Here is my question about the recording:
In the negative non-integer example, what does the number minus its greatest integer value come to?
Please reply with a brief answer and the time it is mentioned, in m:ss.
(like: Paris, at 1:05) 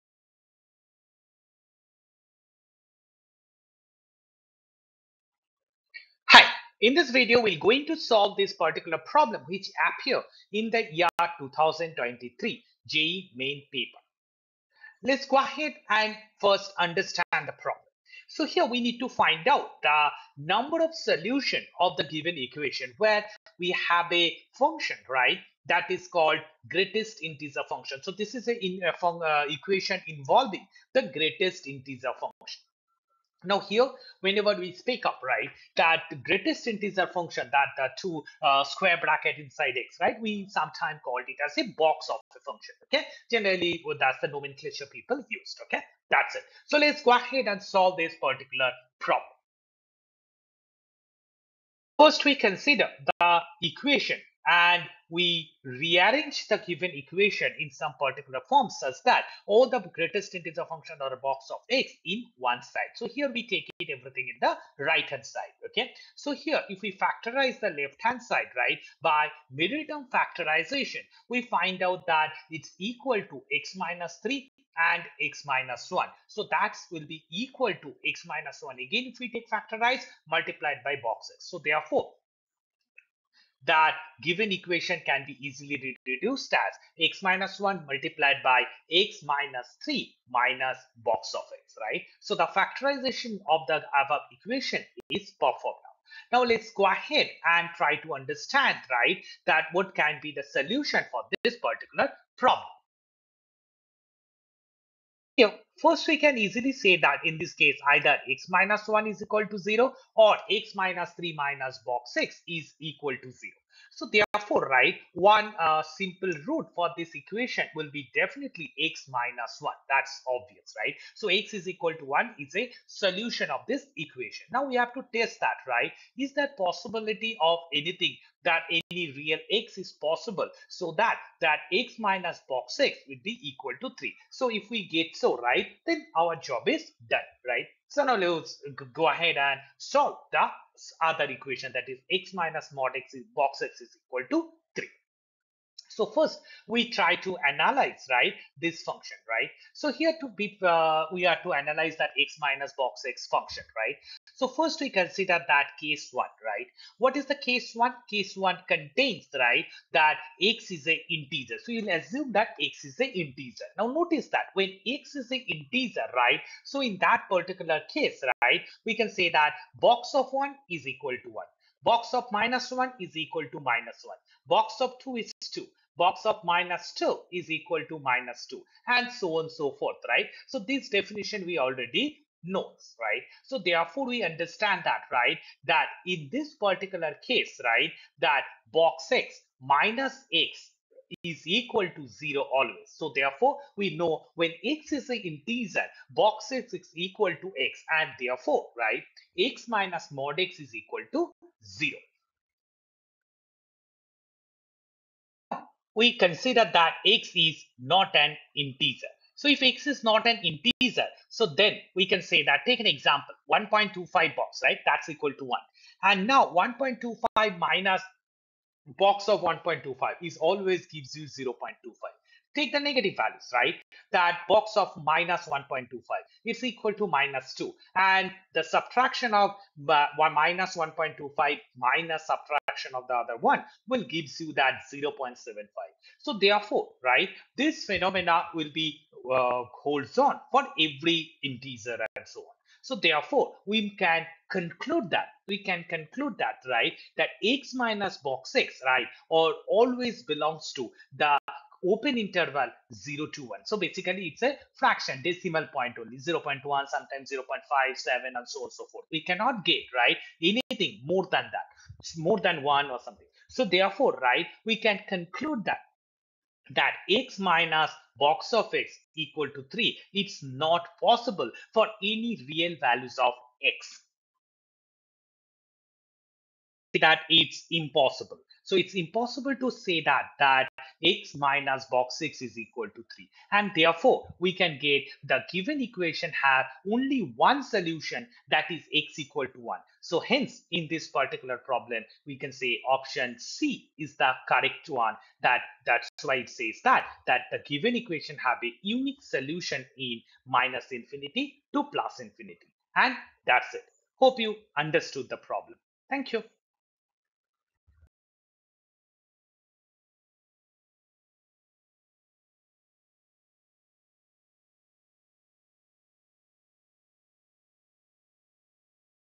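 0.75, at 3:54.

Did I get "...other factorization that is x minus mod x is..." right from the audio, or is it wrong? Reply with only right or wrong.
wrong.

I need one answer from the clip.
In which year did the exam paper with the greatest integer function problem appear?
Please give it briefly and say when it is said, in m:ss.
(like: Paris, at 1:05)
2023, at 0:11.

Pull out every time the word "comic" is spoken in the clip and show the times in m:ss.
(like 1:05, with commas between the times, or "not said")
not said.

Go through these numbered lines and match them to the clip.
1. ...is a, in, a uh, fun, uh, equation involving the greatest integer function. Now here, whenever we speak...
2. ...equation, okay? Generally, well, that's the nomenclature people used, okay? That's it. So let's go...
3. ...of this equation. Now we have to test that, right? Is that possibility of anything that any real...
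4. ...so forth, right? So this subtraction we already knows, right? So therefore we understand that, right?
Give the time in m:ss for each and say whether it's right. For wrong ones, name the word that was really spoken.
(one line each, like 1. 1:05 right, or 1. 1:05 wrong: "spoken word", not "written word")
1. 0:28 right
2. 0:42 wrong: "function", not "equation"
3. 2:03 right
4. 2:59 wrong: "definition", not "subtraction".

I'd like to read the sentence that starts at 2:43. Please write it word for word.
Now notice that when x is a integer, right?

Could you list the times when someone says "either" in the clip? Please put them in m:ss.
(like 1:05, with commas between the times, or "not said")
1:47.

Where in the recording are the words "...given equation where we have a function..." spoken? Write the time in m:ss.
0:22.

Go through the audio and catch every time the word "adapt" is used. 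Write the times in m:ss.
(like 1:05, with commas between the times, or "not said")
not said.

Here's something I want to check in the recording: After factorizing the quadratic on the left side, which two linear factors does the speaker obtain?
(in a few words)
x minus 3 and x minus 1.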